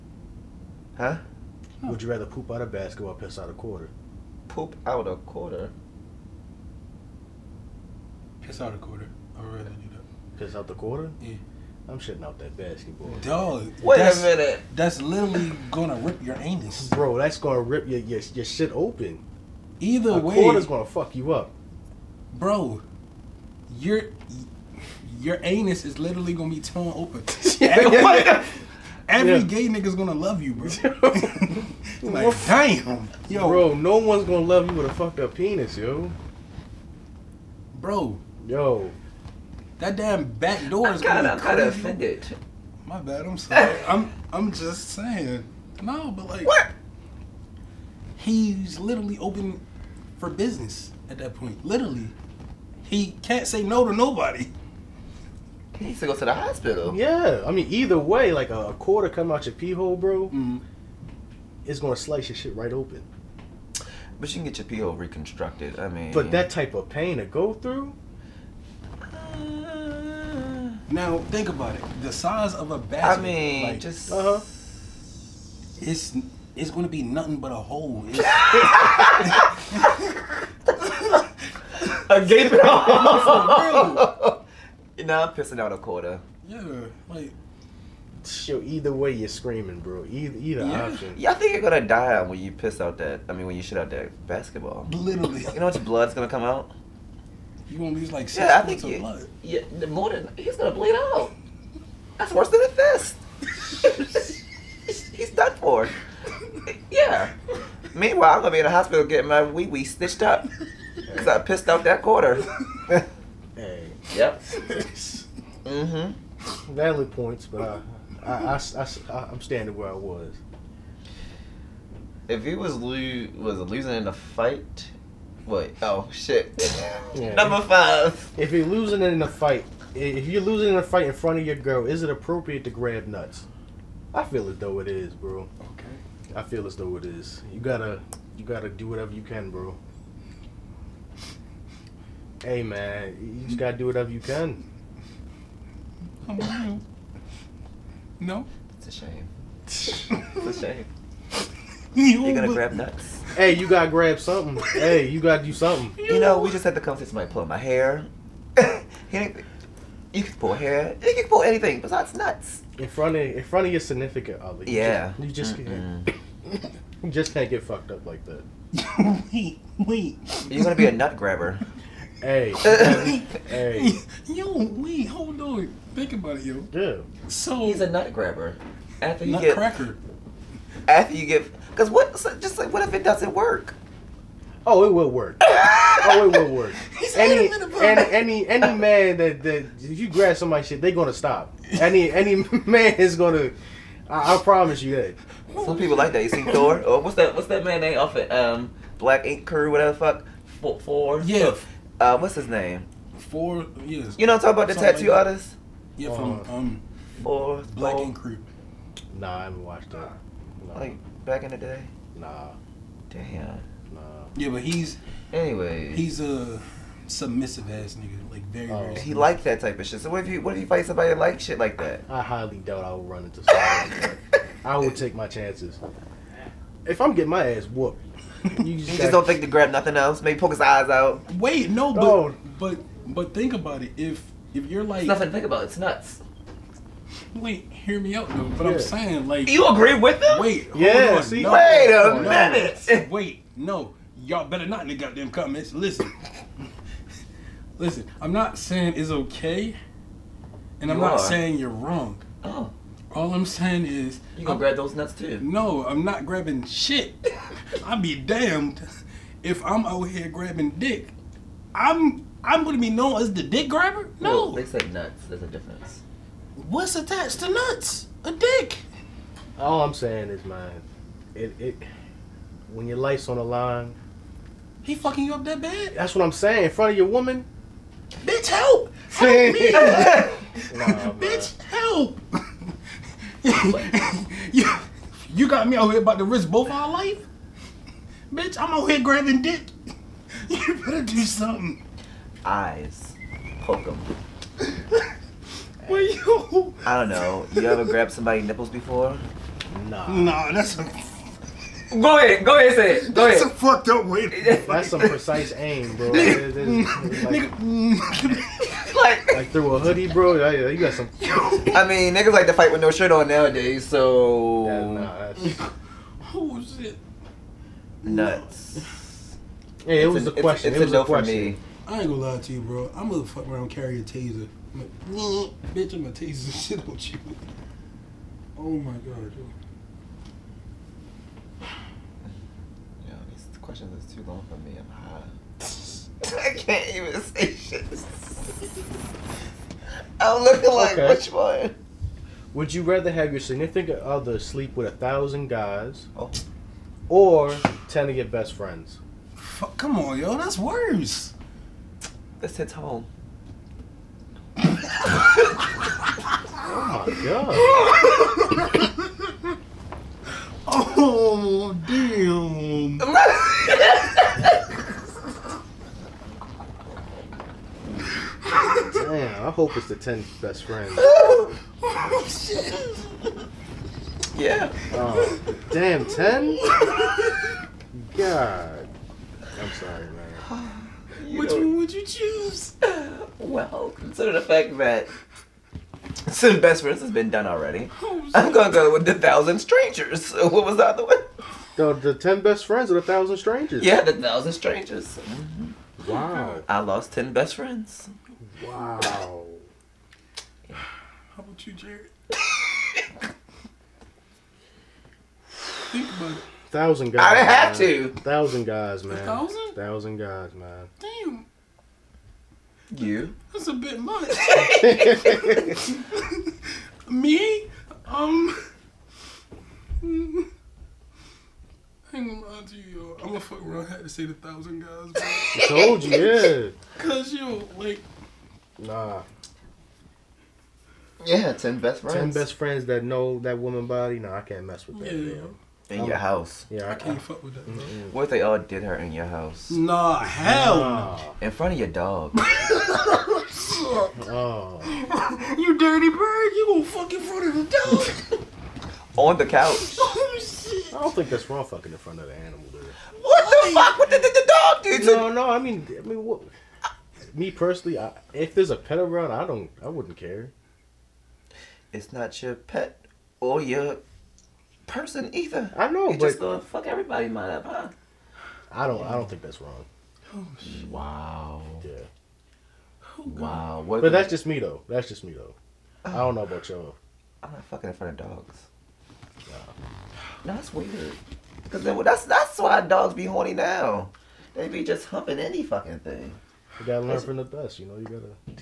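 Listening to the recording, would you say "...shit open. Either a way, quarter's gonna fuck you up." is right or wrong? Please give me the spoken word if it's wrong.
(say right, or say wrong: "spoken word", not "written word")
right.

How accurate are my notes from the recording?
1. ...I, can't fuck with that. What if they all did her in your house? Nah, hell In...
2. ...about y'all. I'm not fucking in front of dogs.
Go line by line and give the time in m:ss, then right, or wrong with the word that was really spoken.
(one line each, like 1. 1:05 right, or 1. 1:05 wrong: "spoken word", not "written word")
1. 7:16 right
2. 7:56 right.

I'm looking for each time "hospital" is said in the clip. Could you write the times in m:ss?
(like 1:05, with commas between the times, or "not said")
0:56, 1:48.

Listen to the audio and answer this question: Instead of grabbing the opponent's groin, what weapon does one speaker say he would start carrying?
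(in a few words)
taser.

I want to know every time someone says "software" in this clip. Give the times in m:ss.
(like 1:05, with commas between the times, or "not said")
not said.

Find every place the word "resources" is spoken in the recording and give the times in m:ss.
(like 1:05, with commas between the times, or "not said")
not said.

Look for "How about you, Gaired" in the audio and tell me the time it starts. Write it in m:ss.
6:40.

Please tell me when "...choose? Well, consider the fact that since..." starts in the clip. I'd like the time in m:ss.
6:22.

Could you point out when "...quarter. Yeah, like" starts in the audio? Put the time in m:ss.
1:25.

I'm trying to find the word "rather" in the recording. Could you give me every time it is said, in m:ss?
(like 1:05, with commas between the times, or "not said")
0:02, 0:09, 5:42.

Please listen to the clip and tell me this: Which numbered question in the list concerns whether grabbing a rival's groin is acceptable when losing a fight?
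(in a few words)
5.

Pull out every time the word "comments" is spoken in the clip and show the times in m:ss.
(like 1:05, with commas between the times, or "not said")
4:05.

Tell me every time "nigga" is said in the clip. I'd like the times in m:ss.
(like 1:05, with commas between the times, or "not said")
0:29, 3:37, 5:06, 5:12.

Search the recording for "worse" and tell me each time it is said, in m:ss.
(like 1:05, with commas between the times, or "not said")
1:42, 5:50.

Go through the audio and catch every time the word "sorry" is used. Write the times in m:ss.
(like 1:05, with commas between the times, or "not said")
0:43, 6:19.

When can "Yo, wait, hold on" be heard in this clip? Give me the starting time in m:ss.
2:54.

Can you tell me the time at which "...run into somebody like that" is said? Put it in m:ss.
3:43.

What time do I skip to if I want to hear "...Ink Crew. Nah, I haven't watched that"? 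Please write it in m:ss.
3:27.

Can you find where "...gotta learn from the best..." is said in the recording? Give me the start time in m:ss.
8:06.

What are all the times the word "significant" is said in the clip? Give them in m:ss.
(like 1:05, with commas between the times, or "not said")
2:43, 5:43.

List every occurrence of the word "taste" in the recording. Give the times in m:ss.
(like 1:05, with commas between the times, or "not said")
5:26.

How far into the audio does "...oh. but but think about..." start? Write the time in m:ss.
3:52.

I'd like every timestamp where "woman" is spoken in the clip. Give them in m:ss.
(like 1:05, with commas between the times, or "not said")
4:37, 7:13.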